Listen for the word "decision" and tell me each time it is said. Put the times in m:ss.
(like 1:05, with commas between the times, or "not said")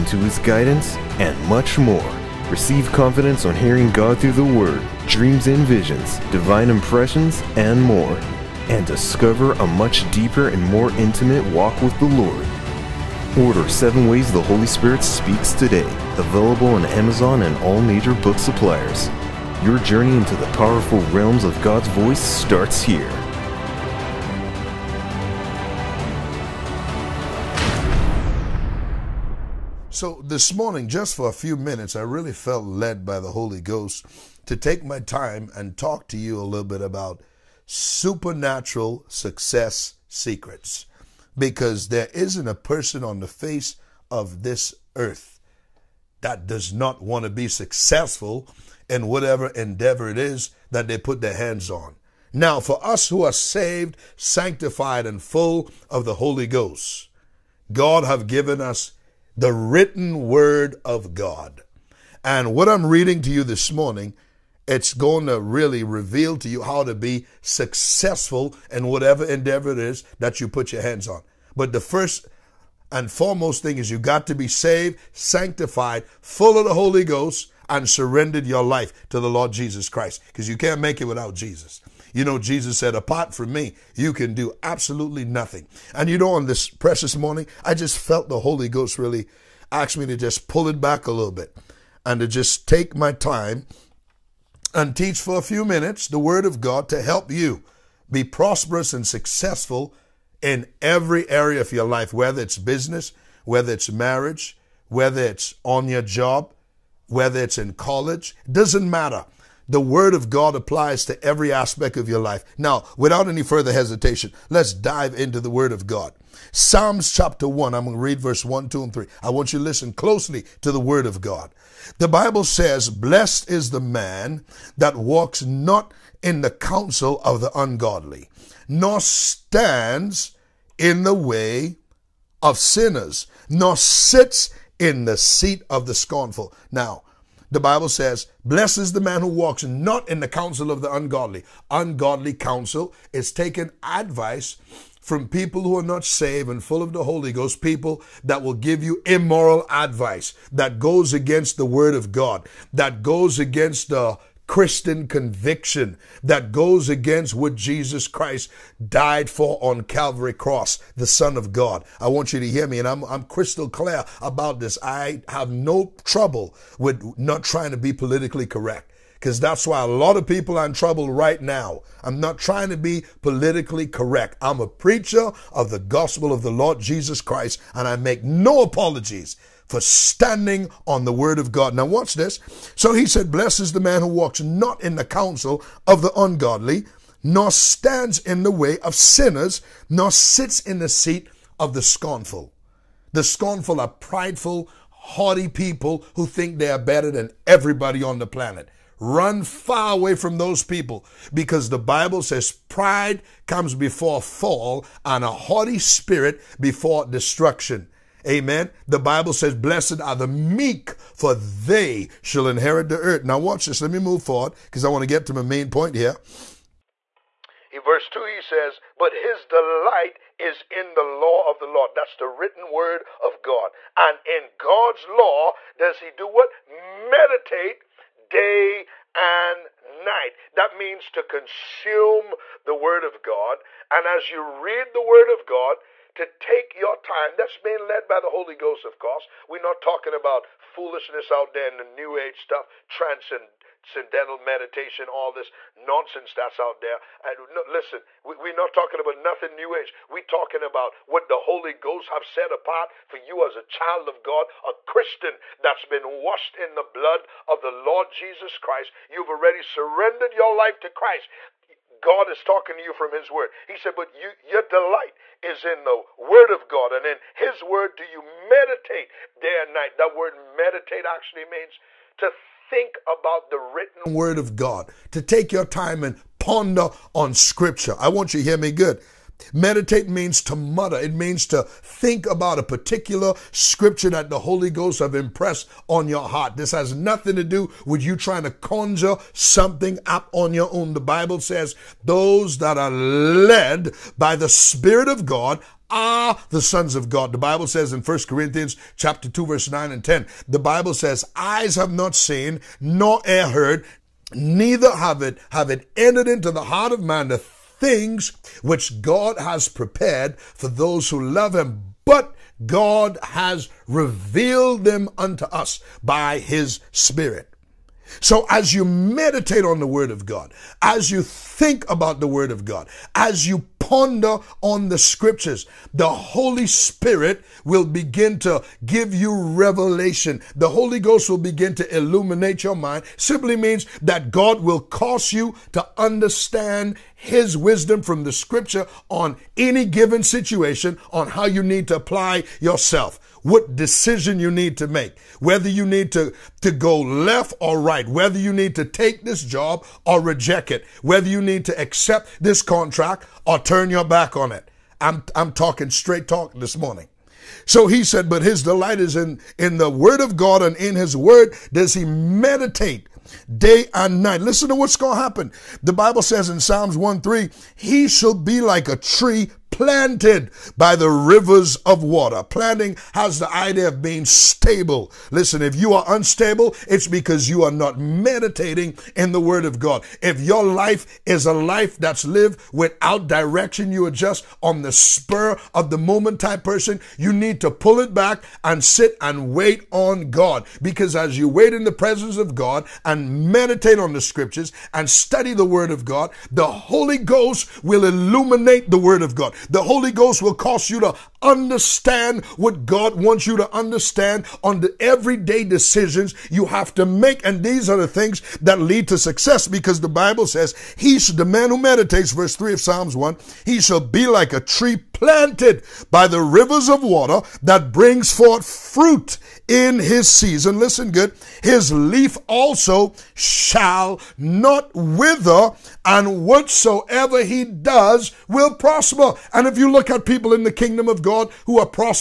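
5:43, 6:45.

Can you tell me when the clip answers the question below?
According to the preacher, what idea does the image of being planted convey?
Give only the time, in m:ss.
6:14.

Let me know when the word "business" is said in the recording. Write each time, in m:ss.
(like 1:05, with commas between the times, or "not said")
1:42.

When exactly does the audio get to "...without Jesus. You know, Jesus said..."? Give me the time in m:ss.
1:21.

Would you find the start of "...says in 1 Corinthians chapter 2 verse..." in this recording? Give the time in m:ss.
4:57.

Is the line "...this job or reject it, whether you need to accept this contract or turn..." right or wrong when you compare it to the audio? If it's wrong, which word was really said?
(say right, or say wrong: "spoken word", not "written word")
right.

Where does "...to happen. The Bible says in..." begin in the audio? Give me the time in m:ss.
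6:05.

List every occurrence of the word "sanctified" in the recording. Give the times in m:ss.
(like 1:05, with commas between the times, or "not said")
0:54, 1:15.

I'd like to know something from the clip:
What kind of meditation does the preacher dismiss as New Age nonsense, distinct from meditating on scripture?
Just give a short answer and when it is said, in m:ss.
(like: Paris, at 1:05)
Transcendental meditation, at 4:02.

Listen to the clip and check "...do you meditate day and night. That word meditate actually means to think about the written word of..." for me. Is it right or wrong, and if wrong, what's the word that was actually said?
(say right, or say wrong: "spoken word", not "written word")
right.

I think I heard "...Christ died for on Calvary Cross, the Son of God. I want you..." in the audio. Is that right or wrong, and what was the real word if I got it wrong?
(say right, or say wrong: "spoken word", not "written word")
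right.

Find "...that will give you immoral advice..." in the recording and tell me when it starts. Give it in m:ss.
2:28.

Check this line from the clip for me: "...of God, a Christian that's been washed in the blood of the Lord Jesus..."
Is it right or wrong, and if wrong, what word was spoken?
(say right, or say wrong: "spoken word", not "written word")
right.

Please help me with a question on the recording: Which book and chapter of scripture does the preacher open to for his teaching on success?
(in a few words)
Psalms 1.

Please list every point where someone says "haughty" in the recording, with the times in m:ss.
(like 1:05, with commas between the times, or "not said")
3:14, 3:25.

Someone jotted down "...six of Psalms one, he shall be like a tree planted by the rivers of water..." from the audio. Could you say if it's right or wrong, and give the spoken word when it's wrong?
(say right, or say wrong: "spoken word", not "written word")
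wrong: "three", not "six".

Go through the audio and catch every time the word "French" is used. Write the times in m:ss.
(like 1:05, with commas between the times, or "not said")
not said.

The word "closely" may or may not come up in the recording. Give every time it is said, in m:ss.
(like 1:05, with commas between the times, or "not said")
1:59.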